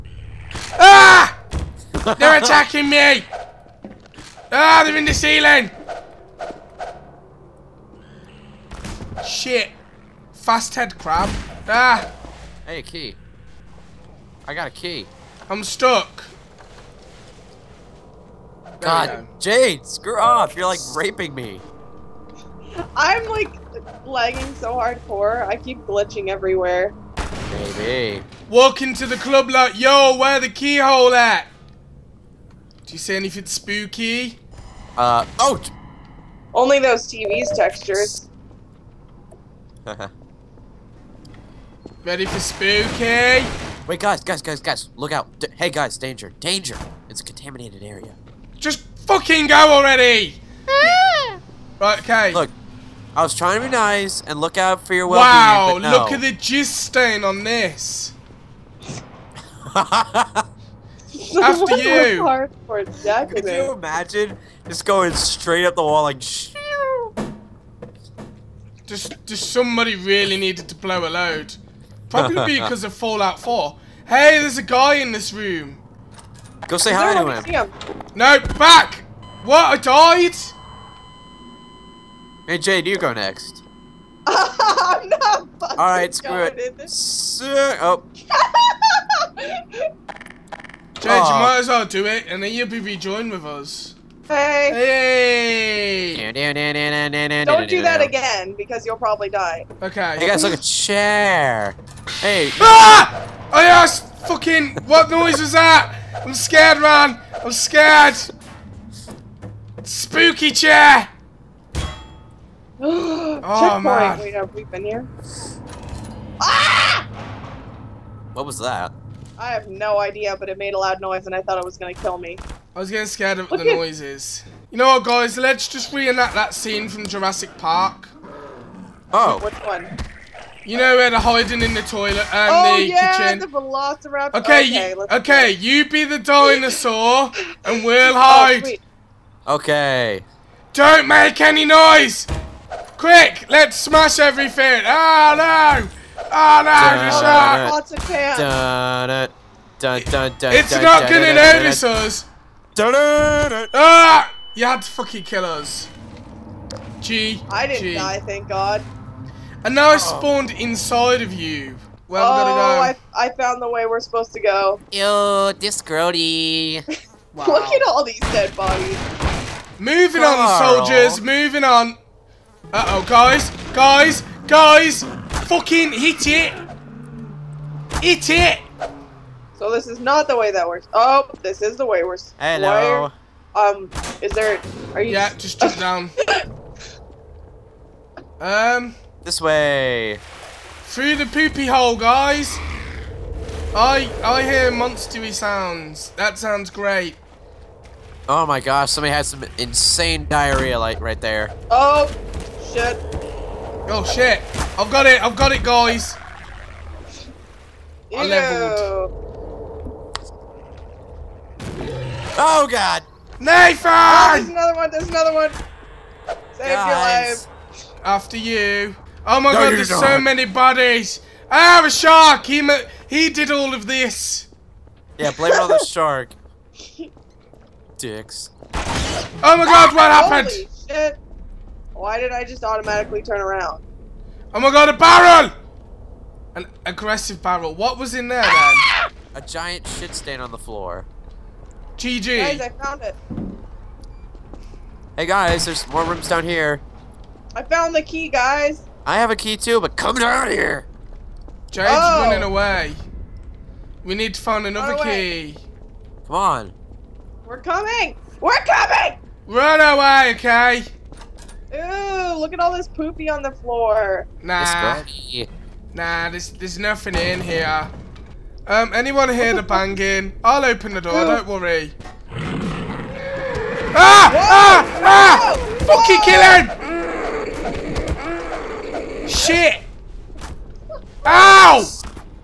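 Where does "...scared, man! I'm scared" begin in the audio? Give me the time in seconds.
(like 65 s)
106 s.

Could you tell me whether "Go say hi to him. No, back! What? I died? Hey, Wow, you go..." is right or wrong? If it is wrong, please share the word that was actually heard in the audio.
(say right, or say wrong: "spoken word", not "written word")
wrong: "Jade", not "Wow".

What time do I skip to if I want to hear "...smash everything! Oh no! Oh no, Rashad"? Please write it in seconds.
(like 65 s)
143 s.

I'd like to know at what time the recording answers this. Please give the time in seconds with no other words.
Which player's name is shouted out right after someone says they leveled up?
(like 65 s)
213 s.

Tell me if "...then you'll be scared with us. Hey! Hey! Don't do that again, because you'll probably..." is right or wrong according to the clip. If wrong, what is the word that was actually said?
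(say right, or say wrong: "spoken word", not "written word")
wrong: "rejoined", not "scared".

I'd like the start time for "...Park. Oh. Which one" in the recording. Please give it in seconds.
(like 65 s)
127 s.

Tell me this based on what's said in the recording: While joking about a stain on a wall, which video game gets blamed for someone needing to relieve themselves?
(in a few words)
Fallout 4.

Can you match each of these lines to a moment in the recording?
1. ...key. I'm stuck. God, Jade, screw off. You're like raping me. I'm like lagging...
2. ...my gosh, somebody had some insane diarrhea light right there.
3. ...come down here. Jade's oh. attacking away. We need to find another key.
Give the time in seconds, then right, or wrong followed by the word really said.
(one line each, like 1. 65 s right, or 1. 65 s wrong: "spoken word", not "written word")
1. 14 s right
2. 198 s right
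3. 249 s wrong: "running", not "attacking".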